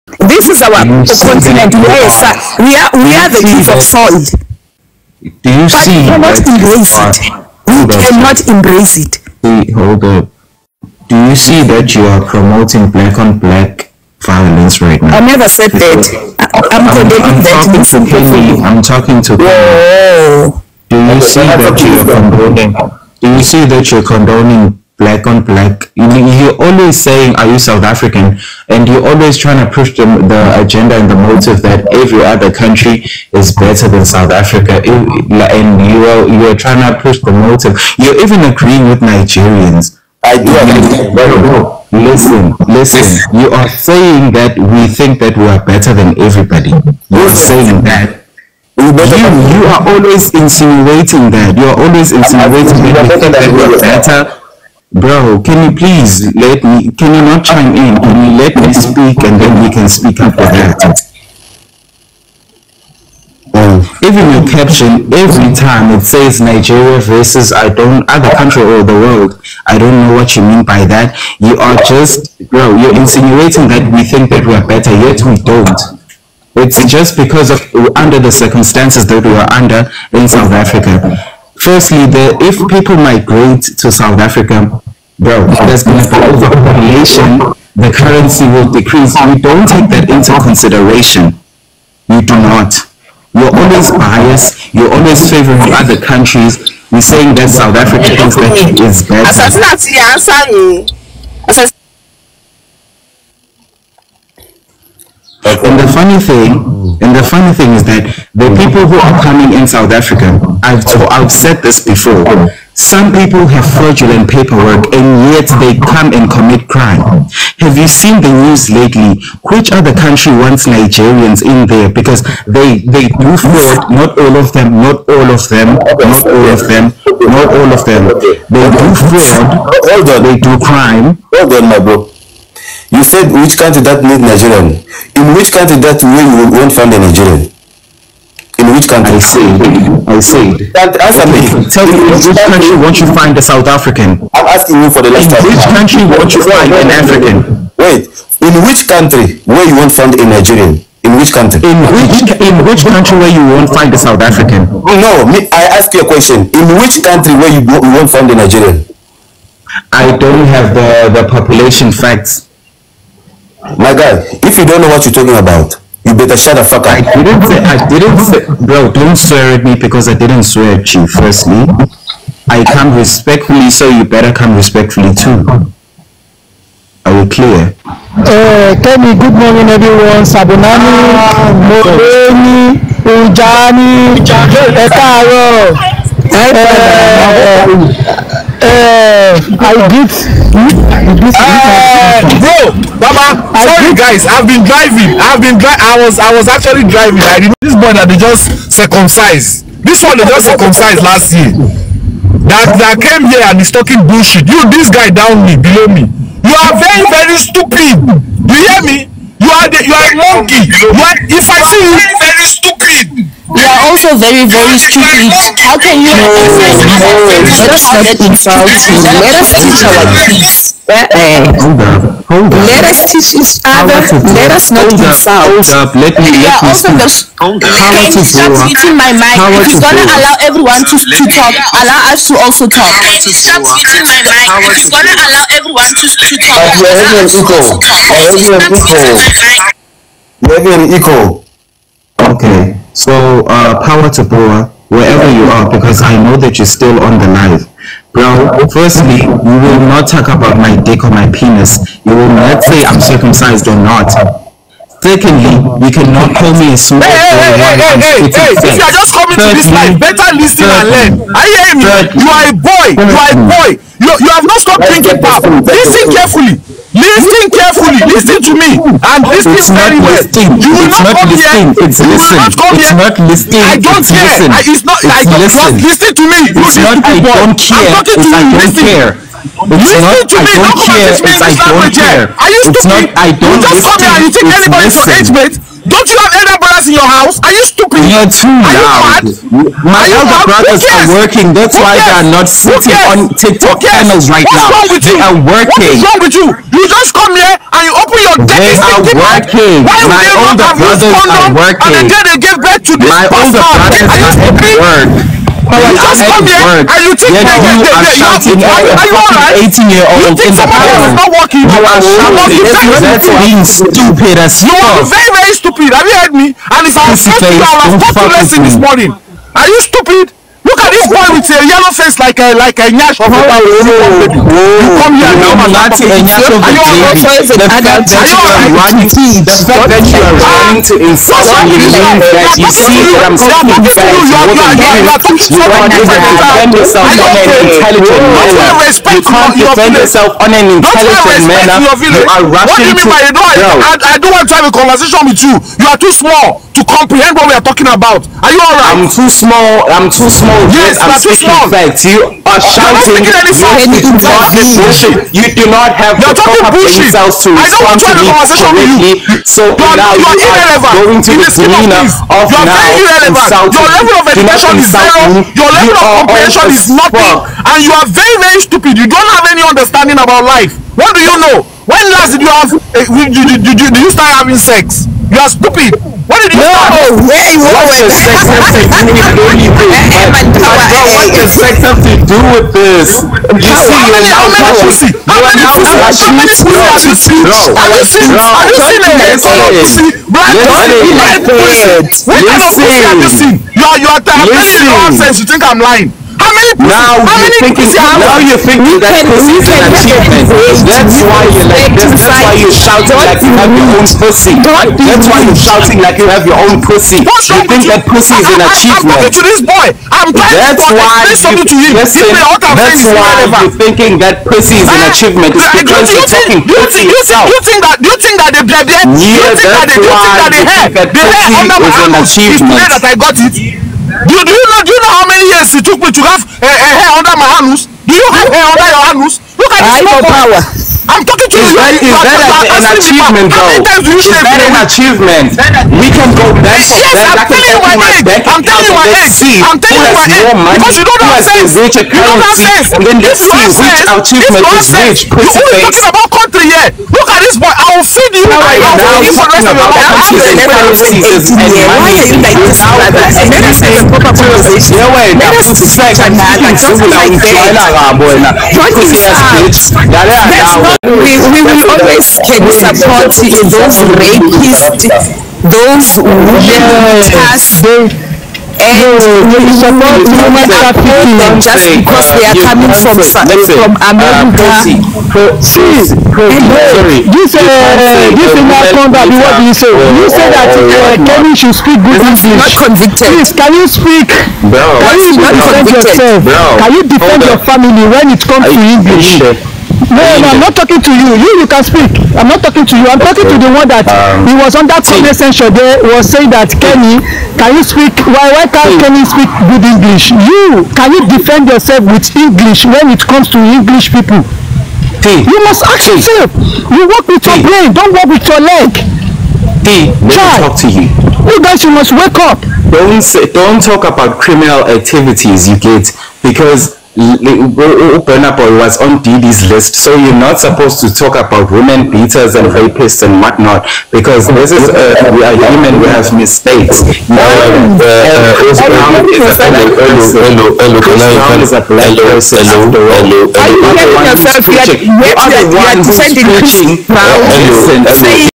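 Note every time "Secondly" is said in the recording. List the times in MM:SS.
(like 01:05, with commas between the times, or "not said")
04:15.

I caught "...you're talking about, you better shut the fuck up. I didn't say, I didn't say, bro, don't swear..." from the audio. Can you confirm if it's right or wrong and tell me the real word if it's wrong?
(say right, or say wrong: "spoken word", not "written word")
right.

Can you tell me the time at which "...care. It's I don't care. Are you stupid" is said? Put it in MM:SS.
04:40.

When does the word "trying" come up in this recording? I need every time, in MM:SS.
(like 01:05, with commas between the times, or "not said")
00:29, 00:36.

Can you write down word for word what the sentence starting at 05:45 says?
You are too small to comprehend what we are talking about.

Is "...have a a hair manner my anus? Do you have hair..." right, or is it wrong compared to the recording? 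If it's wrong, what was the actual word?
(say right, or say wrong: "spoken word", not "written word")
wrong: "under", not "manner".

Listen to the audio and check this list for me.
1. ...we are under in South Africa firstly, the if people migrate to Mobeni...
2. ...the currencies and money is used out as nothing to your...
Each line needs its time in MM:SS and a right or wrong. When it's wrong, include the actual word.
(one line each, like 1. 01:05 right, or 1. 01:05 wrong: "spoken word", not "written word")
1. 01:19 wrong: "South", not "Mobeni"
2. 07:30 wrong: "anything", not "nothing".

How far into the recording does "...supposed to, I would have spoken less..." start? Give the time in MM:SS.
05:17.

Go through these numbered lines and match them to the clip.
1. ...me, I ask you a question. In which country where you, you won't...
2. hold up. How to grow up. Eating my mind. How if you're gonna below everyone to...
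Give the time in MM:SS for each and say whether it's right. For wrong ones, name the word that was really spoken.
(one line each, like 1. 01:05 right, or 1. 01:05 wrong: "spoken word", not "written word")
1. 02:35 right
2. 03:47 wrong: "allow", not "below".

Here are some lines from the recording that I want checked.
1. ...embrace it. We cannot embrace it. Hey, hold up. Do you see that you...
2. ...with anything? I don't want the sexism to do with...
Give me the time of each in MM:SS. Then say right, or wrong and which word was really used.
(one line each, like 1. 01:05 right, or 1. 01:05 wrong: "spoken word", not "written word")
1. 00:06 right
2. 06:18 right.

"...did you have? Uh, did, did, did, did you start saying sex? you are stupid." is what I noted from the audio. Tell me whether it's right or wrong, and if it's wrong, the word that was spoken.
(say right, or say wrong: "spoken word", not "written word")
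wrong: "having", not "saying".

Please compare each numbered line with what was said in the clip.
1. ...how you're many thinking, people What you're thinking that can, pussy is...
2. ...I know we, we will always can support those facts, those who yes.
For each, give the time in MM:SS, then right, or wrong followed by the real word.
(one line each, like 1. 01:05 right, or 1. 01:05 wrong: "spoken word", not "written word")
1. 06:37 wrong: "Now", not "What"
2. 07:40 wrong: "rapists", not "facts".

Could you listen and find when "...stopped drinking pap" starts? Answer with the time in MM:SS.
04:24.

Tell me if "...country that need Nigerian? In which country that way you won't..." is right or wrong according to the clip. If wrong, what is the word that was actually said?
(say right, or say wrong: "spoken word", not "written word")
right.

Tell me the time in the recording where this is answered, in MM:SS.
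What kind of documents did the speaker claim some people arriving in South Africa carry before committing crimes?
01:53.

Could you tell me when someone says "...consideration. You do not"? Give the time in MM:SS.
01:30.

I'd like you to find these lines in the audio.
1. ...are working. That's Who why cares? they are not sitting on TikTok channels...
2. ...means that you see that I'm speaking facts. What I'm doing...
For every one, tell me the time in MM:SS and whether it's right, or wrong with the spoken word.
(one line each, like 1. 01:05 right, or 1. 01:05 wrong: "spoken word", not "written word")
1. 04:50 right
2. 05:31 right.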